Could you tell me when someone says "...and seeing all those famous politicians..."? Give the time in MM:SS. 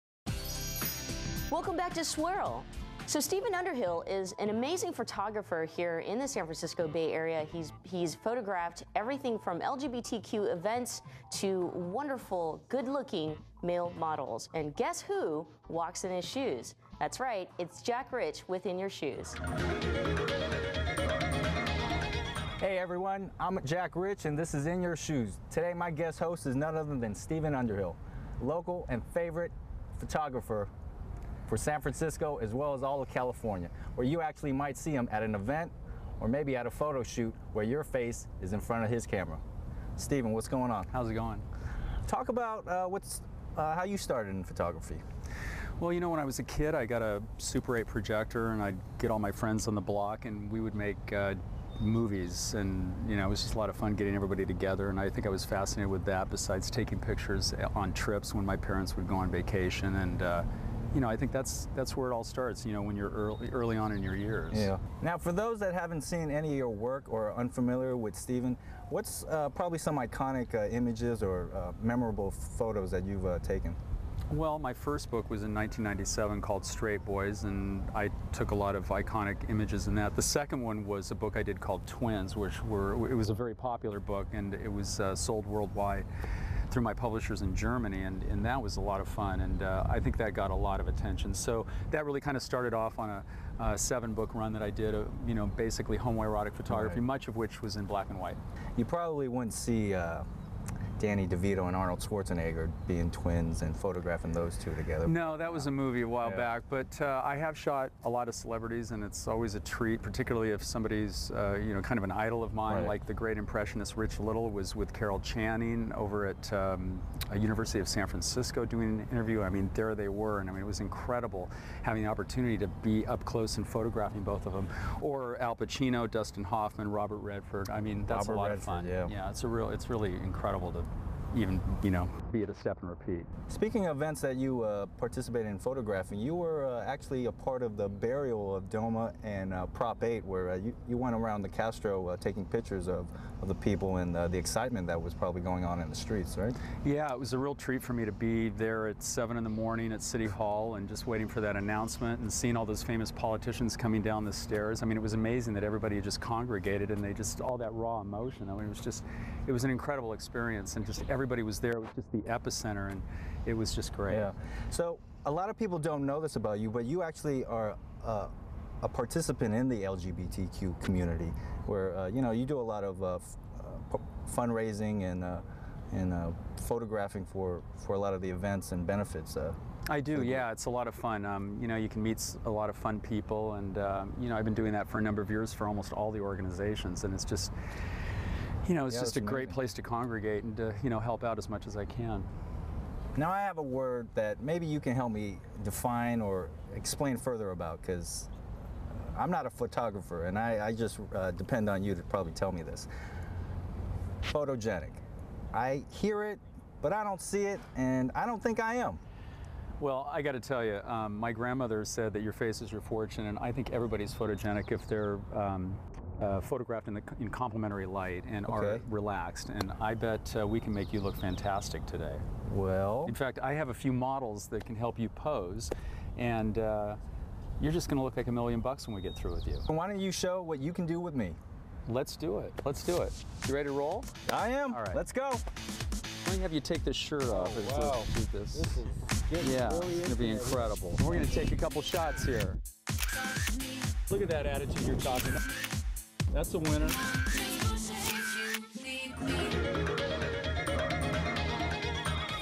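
02:32.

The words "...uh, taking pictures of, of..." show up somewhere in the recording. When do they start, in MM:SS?
02:22.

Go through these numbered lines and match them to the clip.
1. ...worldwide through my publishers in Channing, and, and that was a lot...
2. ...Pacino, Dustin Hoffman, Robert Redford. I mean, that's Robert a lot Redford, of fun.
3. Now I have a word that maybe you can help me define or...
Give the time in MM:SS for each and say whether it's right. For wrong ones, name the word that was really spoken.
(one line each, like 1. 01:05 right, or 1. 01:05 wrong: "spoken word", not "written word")
1. 01:25 wrong: "Germany", not "Channing"
2. 02:05 right
3. 03:13 right.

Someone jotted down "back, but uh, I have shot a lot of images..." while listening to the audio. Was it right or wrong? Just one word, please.
wrong.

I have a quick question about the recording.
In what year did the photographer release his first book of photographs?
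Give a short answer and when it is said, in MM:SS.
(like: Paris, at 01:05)
1997, at 01:15.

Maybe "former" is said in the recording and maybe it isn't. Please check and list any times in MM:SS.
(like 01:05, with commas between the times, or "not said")
not said.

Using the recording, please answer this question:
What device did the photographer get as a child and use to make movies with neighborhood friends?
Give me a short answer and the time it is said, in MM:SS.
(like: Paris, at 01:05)
Super 8 projector, at 00:47.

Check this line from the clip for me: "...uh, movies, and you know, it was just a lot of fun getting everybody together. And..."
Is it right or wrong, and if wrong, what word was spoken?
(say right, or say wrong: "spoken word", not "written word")
right.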